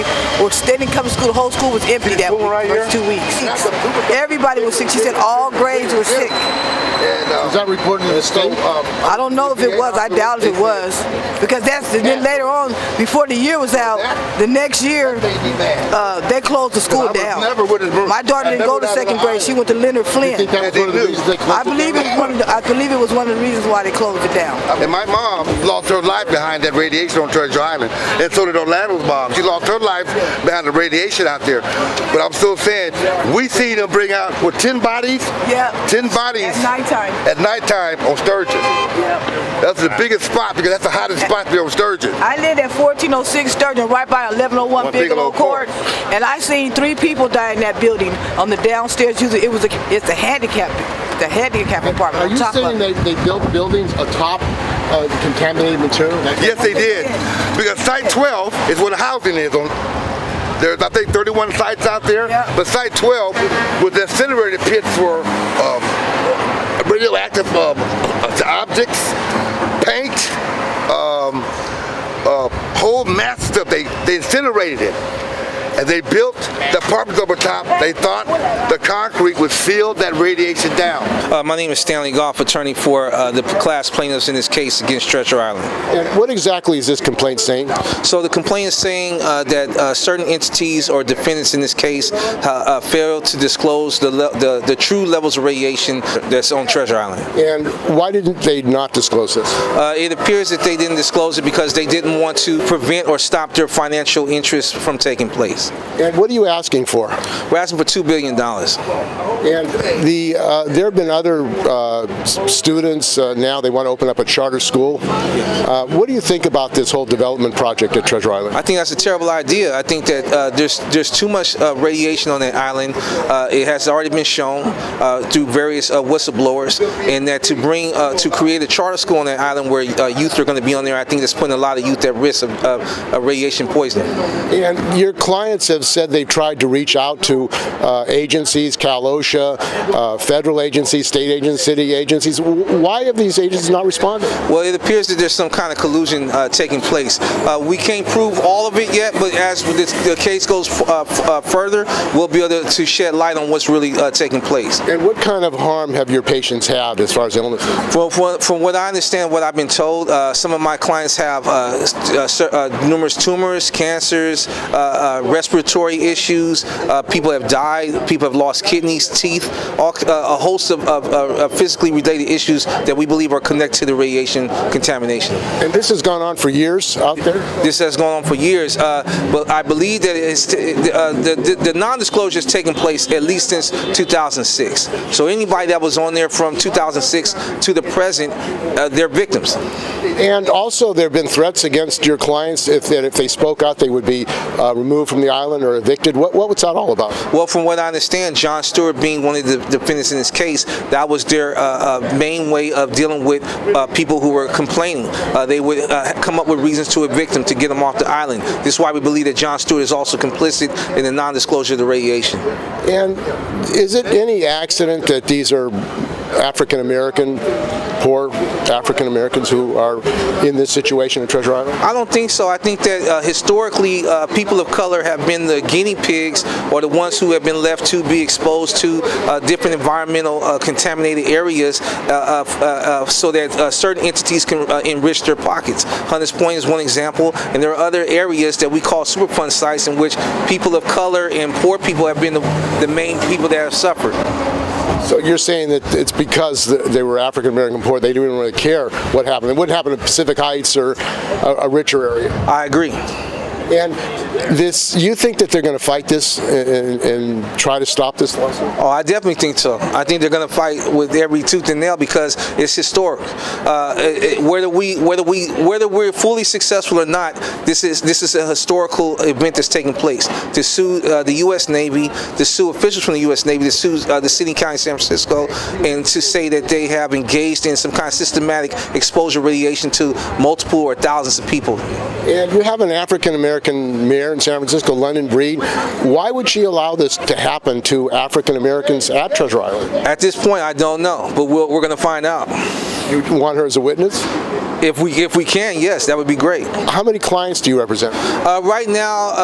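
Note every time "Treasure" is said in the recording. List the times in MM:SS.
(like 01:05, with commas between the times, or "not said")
00:27, 01:25, 01:36, 01:58, 03:41, 04:49.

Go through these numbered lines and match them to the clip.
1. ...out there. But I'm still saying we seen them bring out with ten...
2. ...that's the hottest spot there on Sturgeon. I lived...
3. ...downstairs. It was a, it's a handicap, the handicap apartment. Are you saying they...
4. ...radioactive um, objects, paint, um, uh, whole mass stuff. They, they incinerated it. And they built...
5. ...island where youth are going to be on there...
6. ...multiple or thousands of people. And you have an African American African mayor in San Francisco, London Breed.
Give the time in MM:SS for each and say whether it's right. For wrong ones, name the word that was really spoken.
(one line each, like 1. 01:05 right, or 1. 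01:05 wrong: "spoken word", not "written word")
1. 00:31 right
2. 00:40 right
3. 00:48 right
4. 01:06 right
5. 02:09 right
6. 04:40 right.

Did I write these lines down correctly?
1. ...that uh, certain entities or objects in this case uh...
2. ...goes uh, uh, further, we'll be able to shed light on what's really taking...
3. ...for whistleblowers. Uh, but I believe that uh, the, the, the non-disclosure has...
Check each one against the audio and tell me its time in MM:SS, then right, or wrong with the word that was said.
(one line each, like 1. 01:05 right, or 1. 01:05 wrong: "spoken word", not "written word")
1. 01:29 wrong: "defendants", not "objects"
2. 02:30 right
3. 02:58 wrong: "years", not "whistleblowers".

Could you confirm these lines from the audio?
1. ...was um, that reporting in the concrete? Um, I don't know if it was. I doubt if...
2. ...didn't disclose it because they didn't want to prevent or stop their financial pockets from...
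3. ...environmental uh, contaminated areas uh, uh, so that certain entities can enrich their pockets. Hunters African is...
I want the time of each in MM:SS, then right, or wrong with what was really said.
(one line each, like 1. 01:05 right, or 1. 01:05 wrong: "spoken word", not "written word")
1. 00:07 wrong: "state", not "concrete"
2. 01:40 wrong: "interests", not "pockets"
3. 03:49 wrong: "Point", not "African".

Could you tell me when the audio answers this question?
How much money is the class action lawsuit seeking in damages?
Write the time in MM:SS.
01:47.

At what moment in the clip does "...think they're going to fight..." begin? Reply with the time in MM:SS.
04:20.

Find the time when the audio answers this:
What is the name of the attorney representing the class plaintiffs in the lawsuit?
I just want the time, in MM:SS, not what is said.
01:21.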